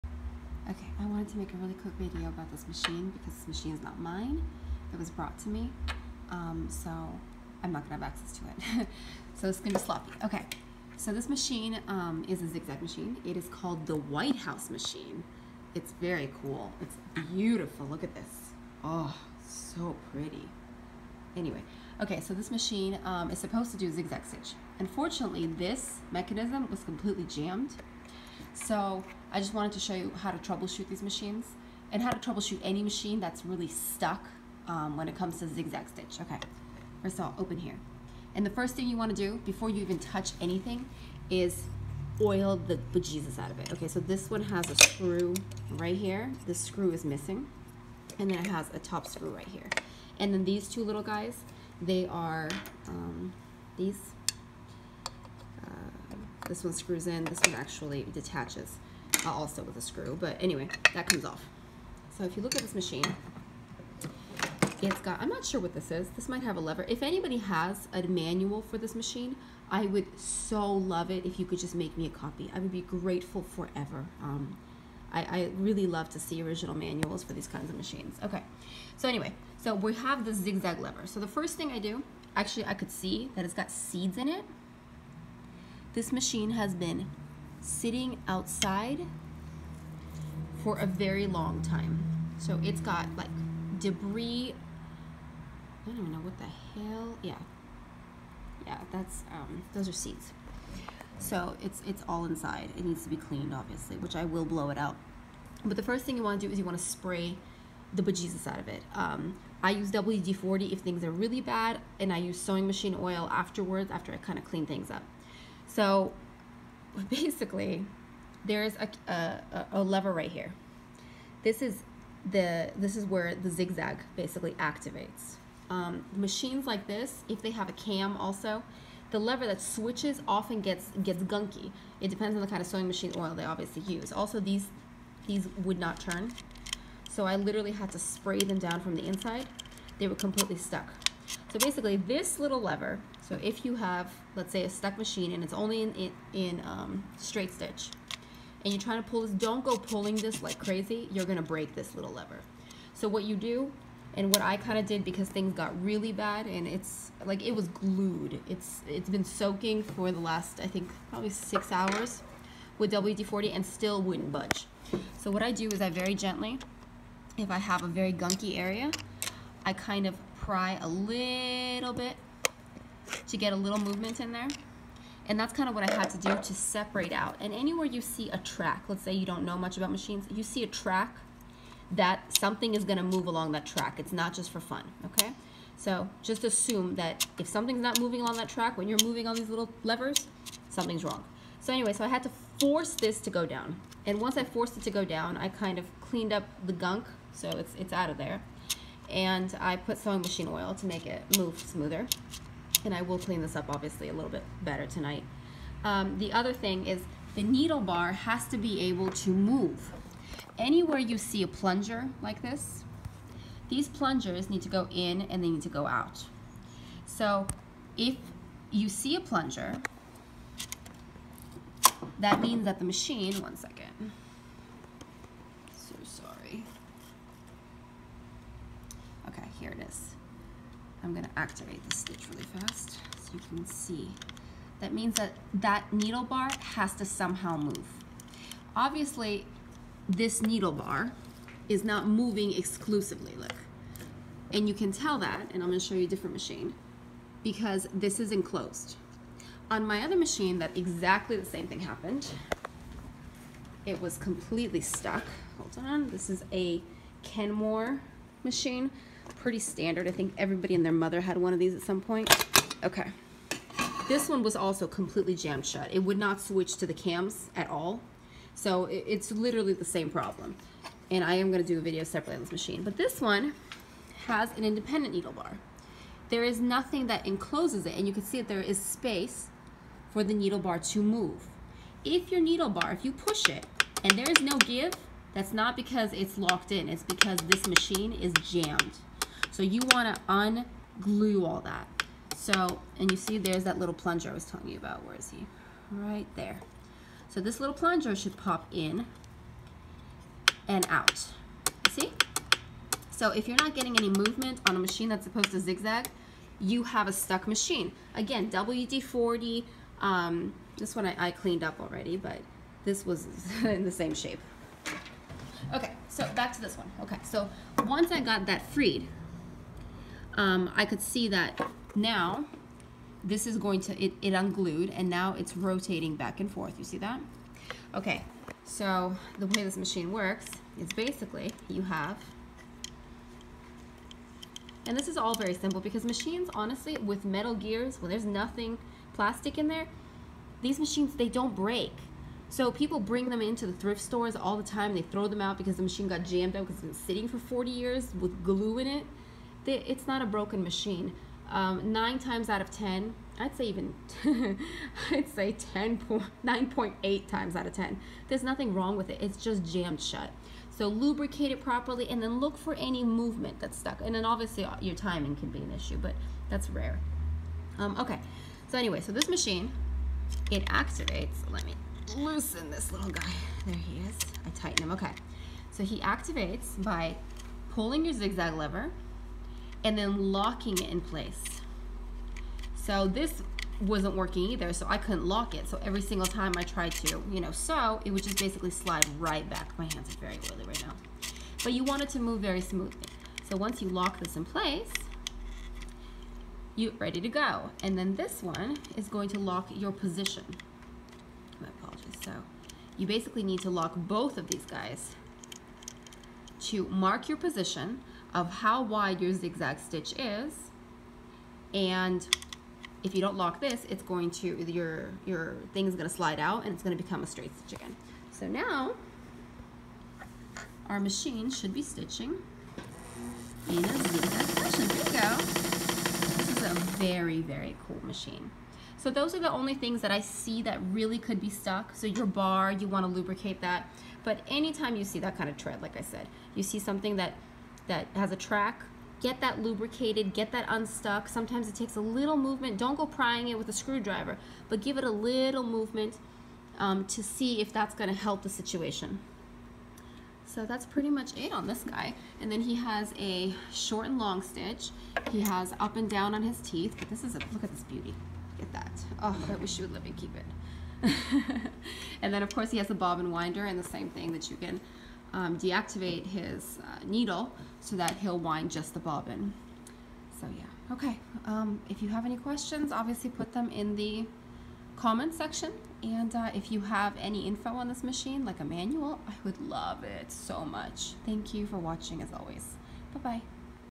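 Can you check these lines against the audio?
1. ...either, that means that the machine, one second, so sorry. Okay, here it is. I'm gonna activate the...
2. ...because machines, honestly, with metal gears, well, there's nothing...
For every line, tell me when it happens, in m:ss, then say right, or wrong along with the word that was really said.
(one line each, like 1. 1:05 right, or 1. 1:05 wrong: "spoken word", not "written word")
1. 3:39 wrong: "plunger", not "either"
2. 5:35 right.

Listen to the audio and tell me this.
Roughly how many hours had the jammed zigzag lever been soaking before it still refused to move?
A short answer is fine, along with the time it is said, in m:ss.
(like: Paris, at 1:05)
6, at 2:41.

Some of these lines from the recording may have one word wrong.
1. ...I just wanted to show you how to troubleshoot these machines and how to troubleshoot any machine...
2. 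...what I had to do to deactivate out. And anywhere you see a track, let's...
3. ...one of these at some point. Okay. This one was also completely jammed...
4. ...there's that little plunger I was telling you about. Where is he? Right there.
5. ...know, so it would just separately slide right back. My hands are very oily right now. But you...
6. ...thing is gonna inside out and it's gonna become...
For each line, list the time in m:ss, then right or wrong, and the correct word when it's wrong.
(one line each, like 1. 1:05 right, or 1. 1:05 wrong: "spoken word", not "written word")
1. 0:29 right
2. 2:55 wrong: "separate", not "deactivate"
3. 4:21 right
4. 4:53 right
5. 6:27 wrong: "basically", not "separately"
6. 6:55 wrong: "slide", not "inside".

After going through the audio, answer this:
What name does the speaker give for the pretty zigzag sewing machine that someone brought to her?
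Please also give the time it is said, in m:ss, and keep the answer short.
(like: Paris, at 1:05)
White House, at 0:13.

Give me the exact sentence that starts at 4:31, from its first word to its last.
And I am going to do a video separately on this machine.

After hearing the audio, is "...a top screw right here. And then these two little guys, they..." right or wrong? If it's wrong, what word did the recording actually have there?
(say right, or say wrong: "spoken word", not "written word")
right.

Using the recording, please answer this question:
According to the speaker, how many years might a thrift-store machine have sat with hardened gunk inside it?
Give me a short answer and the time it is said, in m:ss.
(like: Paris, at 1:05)
40, at 5:47.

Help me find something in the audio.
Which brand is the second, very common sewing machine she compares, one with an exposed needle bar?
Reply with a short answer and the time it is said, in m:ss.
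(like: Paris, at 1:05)
Kenmore, at 4:17.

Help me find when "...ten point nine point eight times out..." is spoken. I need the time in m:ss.
5:55.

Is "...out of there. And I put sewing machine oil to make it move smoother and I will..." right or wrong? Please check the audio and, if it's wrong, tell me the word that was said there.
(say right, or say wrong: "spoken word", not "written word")
right.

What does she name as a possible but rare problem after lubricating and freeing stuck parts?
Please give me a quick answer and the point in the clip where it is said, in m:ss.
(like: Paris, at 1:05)
Timing, at 6:04.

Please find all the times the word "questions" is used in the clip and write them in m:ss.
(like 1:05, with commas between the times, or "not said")
7:52.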